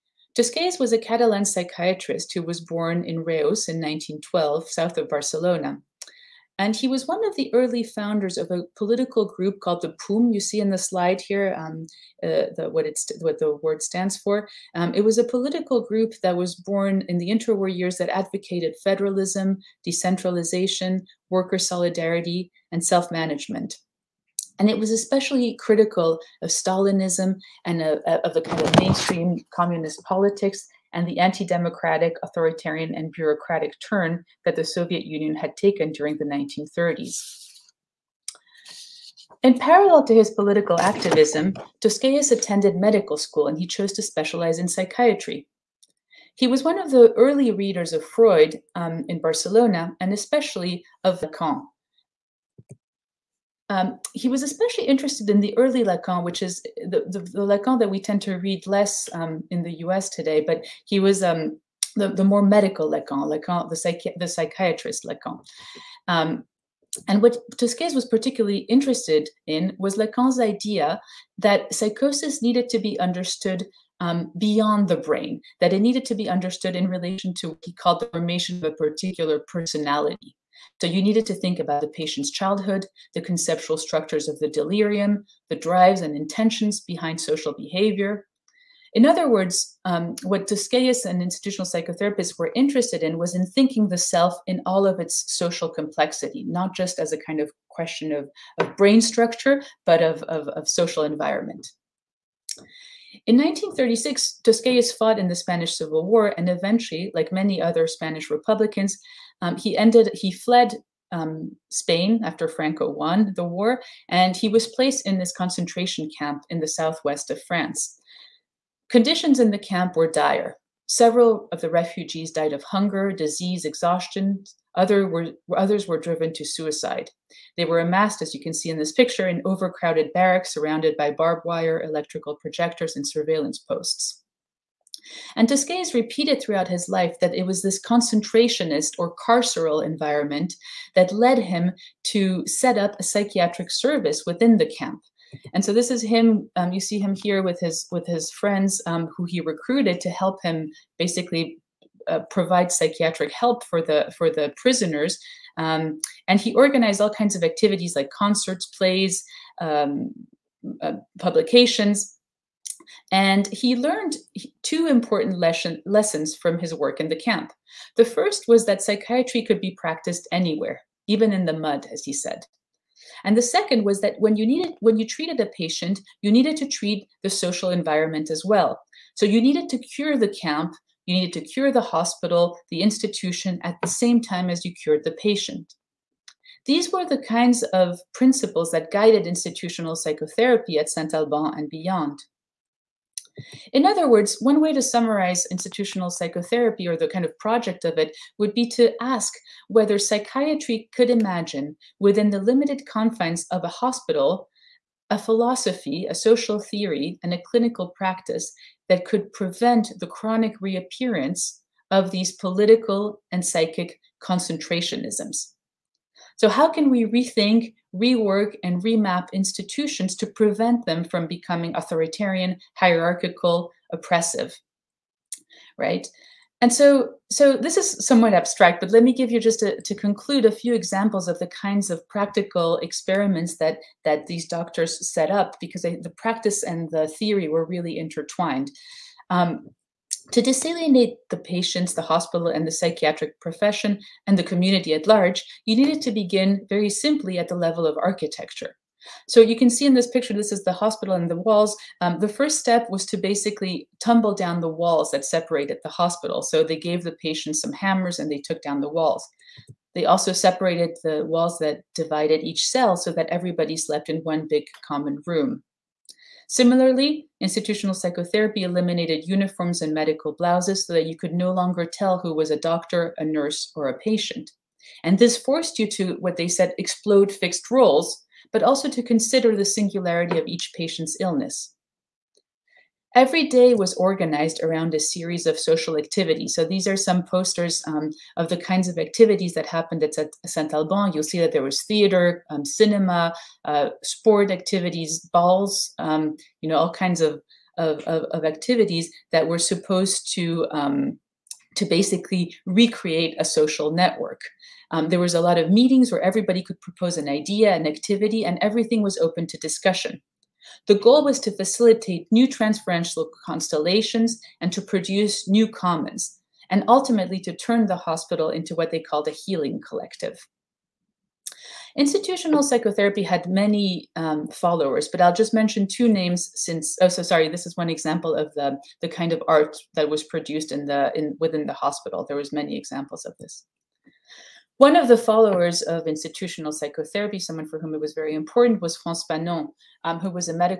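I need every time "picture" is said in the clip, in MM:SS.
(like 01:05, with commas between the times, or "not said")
02:08, 04:10.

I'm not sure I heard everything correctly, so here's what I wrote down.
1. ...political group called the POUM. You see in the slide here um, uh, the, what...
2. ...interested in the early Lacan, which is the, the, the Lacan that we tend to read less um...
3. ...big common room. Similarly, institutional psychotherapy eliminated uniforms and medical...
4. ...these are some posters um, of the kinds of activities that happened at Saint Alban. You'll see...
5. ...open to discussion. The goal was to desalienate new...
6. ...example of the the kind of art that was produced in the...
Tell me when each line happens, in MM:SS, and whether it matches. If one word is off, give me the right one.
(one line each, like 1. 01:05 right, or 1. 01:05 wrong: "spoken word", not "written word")
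1. 00:08 right
2. 00:54 right
3. 04:24 right
4. 04:46 right
5. 05:09 wrong: "facilitate", not "desalienate"
6. 05:27 right.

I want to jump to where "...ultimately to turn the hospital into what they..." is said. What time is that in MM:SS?
05:16.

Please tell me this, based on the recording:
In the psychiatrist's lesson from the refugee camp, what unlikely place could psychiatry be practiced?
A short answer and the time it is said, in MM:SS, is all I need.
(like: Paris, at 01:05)
in the mud, at 02:51.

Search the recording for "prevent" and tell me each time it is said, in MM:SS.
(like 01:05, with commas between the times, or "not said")
03:29, 03:40.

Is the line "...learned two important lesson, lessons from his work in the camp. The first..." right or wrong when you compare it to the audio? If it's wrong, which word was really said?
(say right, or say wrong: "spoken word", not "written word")
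right.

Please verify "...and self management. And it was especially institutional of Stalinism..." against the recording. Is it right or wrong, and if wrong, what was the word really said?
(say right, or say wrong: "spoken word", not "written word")
wrong: "critical", not "institutional".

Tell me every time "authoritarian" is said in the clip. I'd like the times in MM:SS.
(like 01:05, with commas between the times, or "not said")
00:32, 03:41.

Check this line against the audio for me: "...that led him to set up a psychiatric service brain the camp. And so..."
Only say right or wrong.
wrong.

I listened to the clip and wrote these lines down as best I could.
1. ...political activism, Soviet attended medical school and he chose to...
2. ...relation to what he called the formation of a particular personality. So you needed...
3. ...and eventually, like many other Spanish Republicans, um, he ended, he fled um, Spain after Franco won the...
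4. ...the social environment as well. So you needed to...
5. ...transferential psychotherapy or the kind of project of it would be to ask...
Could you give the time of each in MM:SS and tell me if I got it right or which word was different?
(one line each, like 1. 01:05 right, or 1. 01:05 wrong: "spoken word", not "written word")
1. 00:40 wrong: "Tosquelles", not "Soviet"
2. 01:16 right
3. 01:46 right
4. 02:57 right
5. 03:15 wrong: "institutional", not "transferential".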